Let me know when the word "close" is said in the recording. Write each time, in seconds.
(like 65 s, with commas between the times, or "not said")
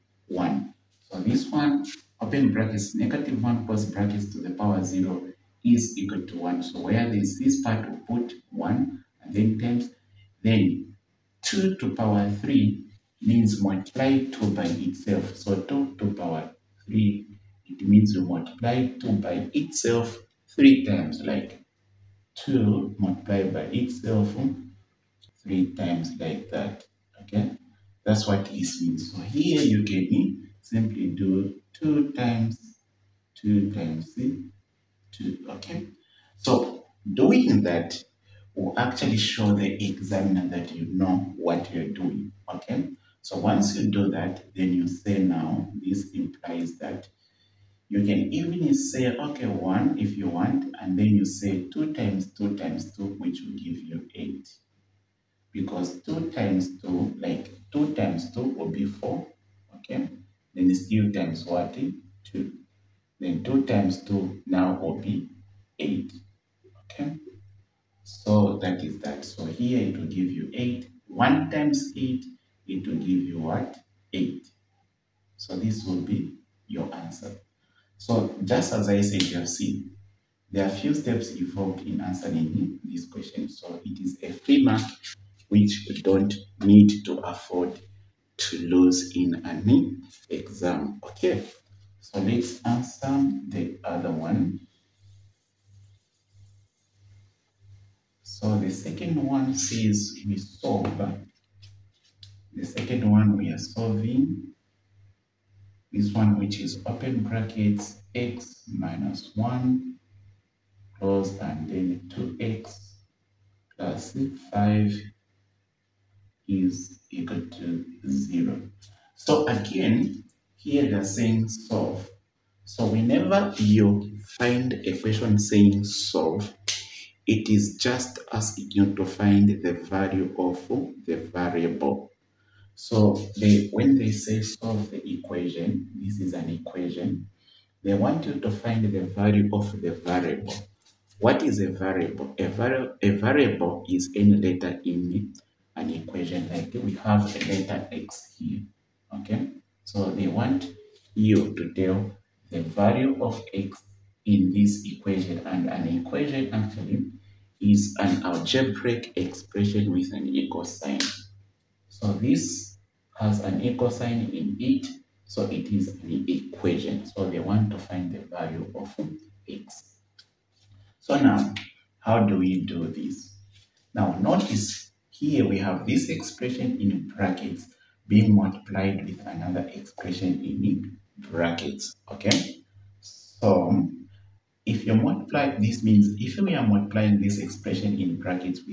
3 s, 110 s.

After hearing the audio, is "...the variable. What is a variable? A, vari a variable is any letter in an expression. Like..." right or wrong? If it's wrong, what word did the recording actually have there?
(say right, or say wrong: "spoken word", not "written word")
wrong: "equation", not "expression".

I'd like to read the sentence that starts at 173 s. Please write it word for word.
Now notice here we have this expression in brackets being multiplied with another expression in brackets, okay?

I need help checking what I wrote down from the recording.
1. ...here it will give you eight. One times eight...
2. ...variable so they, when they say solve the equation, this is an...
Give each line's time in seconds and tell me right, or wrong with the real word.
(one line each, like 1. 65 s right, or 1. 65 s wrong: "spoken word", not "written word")
1. 69 s right
2. 131 s right.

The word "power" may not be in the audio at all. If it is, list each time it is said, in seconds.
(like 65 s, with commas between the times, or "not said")
4 s, 11 s, 16 s.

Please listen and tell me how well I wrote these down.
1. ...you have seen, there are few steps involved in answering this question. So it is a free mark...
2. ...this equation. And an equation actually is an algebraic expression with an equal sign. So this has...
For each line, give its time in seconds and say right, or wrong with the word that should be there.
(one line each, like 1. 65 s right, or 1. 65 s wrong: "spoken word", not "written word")
1. 79 s right
2. 154 s right.